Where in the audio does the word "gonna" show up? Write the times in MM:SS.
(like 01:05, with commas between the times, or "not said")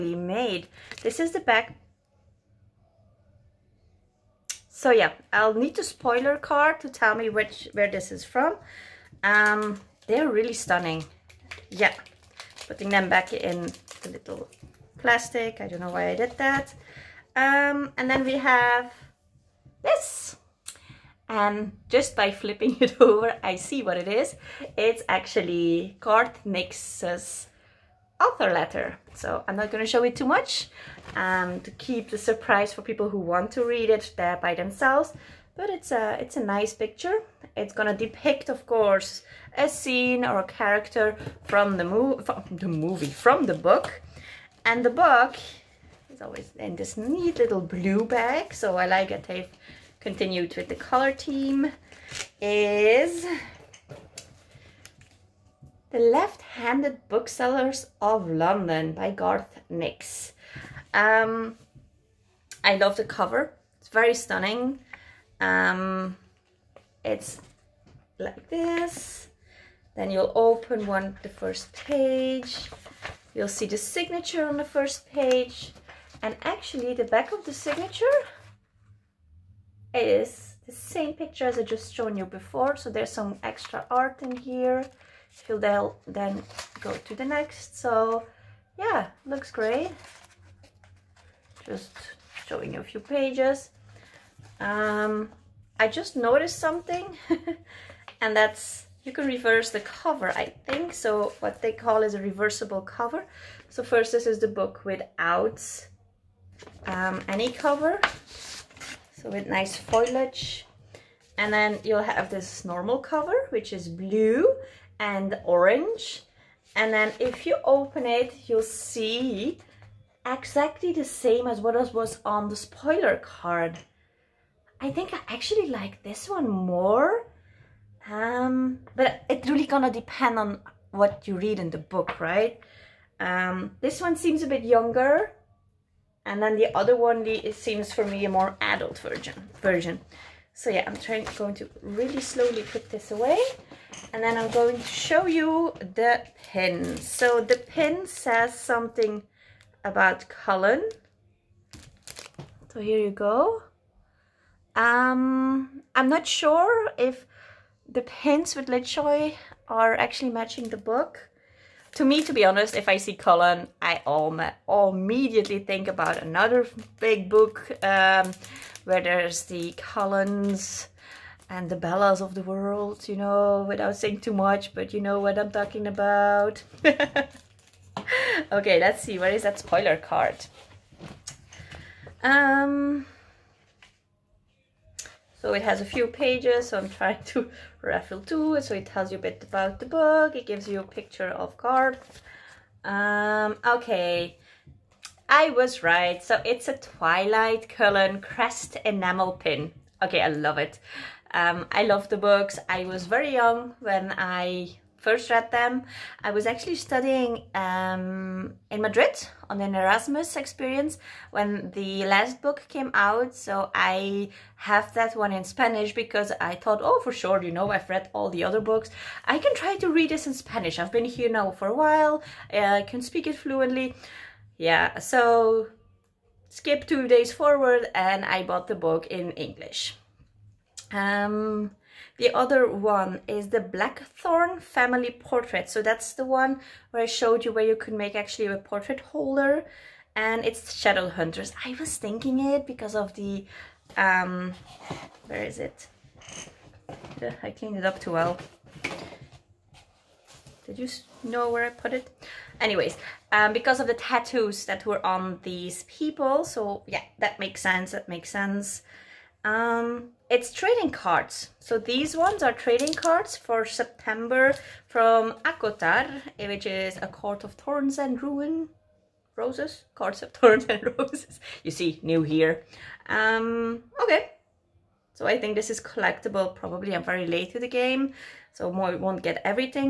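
00:37, 02:09.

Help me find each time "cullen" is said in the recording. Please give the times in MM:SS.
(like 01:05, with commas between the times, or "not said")
02:30, 02:43, 02:49, 03:17.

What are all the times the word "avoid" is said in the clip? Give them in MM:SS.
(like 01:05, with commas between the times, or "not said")
not said.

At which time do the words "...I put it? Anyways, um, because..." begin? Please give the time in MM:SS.
04:11.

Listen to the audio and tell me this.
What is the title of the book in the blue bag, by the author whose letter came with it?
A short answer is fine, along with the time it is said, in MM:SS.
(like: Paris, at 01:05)
The Left-Handed Booksellers of London, at 00:55.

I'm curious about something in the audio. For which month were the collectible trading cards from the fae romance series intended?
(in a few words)
September.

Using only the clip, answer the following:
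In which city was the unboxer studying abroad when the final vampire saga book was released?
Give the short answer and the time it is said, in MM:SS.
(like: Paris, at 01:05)
Madrid, at 03:28.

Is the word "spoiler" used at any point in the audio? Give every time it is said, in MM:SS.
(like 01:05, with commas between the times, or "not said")
00:05, 02:02, 02:59.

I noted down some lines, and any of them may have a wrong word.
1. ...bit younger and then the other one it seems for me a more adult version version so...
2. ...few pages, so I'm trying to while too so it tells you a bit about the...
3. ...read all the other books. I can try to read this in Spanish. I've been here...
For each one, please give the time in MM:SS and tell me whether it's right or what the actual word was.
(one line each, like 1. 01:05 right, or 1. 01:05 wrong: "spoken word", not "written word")
1. 02:14 right
2. 03:05 wrong: "raffle", not "while"
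3. 03:37 right.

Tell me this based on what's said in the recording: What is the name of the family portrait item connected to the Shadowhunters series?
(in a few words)
Blackthorn Family Portrait.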